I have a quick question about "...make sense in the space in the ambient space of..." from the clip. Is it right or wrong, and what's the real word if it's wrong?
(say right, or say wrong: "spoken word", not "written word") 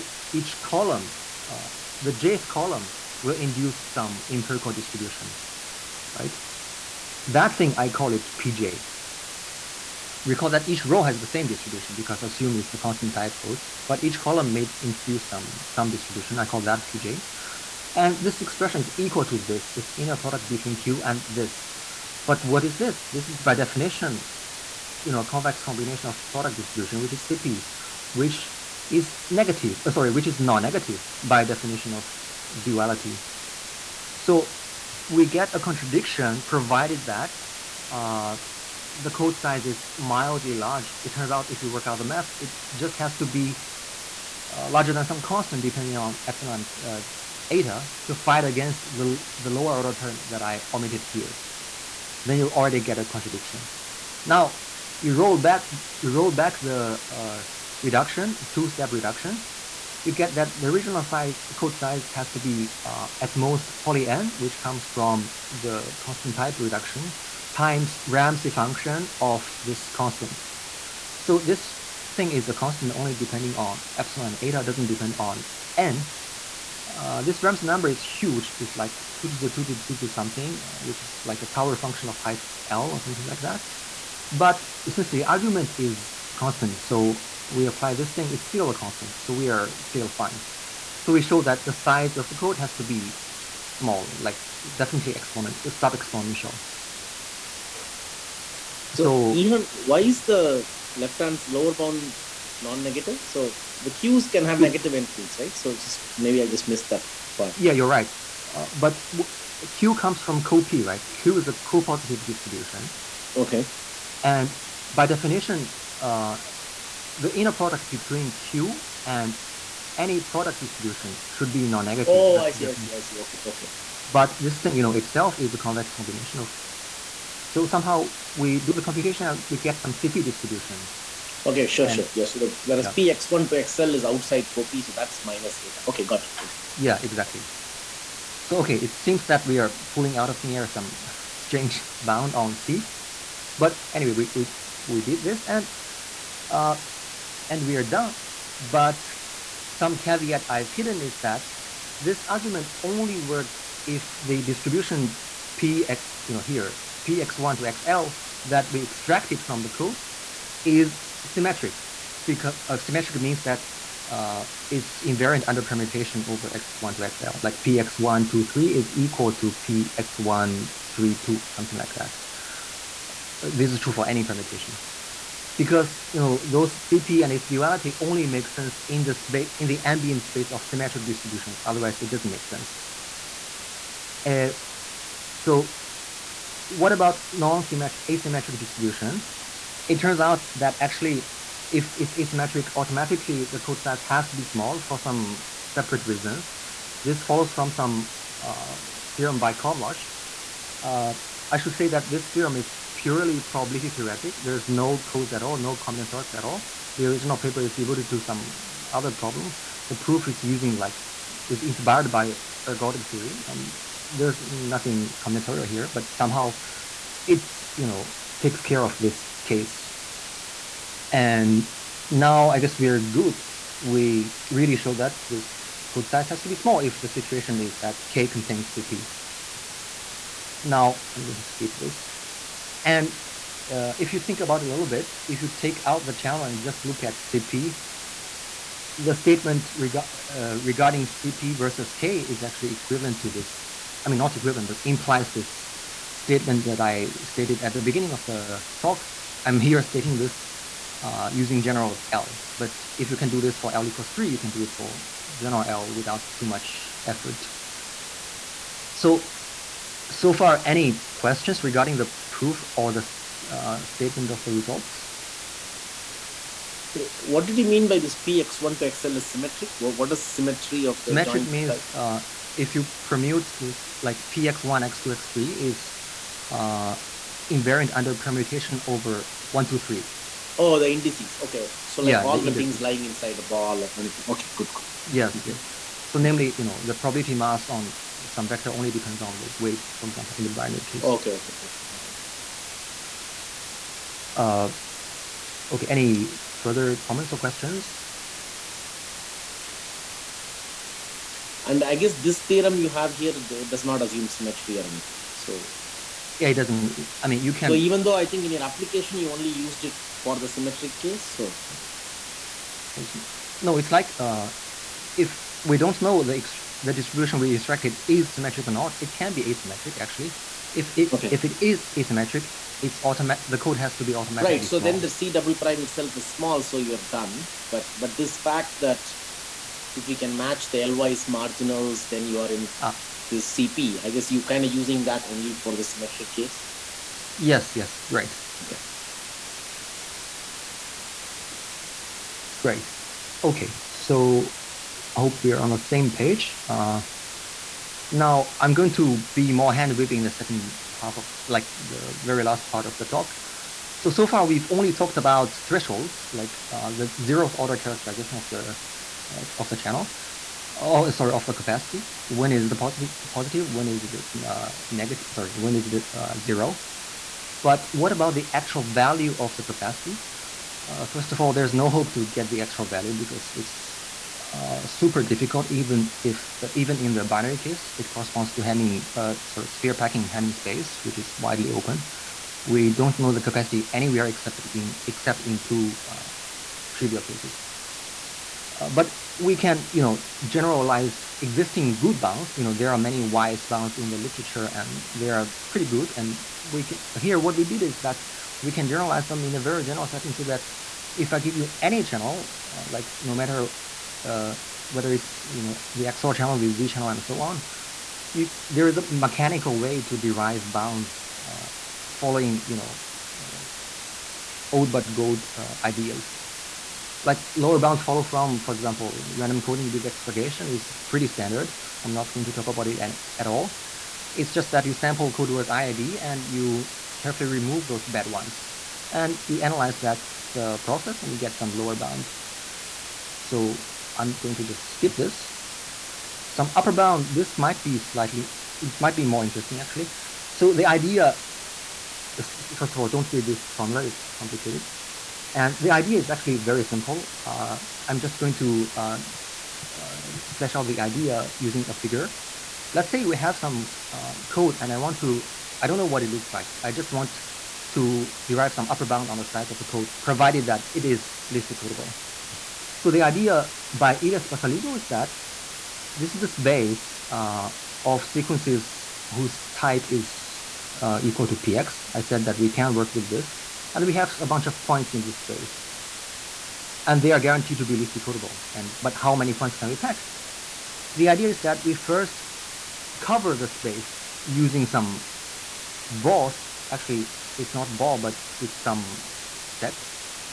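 right.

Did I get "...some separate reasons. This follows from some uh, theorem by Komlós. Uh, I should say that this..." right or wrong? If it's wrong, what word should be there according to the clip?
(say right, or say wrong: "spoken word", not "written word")
right.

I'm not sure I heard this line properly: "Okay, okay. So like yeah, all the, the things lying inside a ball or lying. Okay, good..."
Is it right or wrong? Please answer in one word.
wrong.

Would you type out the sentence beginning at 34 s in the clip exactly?
So we get a contradiction provided that uh, the code size is mildly large.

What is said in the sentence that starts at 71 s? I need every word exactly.
So this thing is a constant only depending on epsilon and eta doesn't depend on n.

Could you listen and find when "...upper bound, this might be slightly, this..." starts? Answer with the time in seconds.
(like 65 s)
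436 s.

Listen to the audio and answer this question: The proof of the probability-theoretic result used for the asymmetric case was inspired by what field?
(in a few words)
ergodic theory.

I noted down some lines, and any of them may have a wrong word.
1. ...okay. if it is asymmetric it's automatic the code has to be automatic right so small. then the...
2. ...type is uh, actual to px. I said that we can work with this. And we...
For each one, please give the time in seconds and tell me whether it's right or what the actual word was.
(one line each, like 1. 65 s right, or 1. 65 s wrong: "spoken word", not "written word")
1. 321 s right
2. 469 s wrong: "equal", not "actual".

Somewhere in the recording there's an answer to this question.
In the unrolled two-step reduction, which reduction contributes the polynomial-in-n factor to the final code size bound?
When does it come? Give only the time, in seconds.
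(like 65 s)
66 s.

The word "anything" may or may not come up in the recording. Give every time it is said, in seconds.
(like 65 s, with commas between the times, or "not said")
284 s, 304 s.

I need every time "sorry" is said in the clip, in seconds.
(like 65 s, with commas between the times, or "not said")
29 s, 361 s, 365 s, 379 s.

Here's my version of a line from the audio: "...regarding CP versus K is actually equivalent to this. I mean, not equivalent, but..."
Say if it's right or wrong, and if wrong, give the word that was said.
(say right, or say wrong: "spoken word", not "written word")
right.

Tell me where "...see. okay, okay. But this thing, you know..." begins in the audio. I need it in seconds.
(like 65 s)
123 s.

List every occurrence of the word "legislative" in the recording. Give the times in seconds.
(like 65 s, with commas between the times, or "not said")
not said.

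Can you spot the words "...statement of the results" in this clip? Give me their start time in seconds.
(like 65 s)
263 s.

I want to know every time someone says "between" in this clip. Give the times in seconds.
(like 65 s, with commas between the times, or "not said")
20 s, 117 s.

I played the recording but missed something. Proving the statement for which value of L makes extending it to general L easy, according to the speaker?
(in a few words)
3.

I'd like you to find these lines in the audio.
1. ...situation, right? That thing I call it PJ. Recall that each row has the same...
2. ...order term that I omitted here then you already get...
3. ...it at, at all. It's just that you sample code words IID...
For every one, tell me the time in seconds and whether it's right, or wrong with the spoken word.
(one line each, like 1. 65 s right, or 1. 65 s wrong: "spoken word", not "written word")
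1. 4 s wrong: "distribution", not "situation"
2. 49 s right
3. 422 s right.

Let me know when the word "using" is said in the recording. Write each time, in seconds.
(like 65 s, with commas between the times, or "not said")
210 s, 251 s, 334 s, 451 s, 484 s.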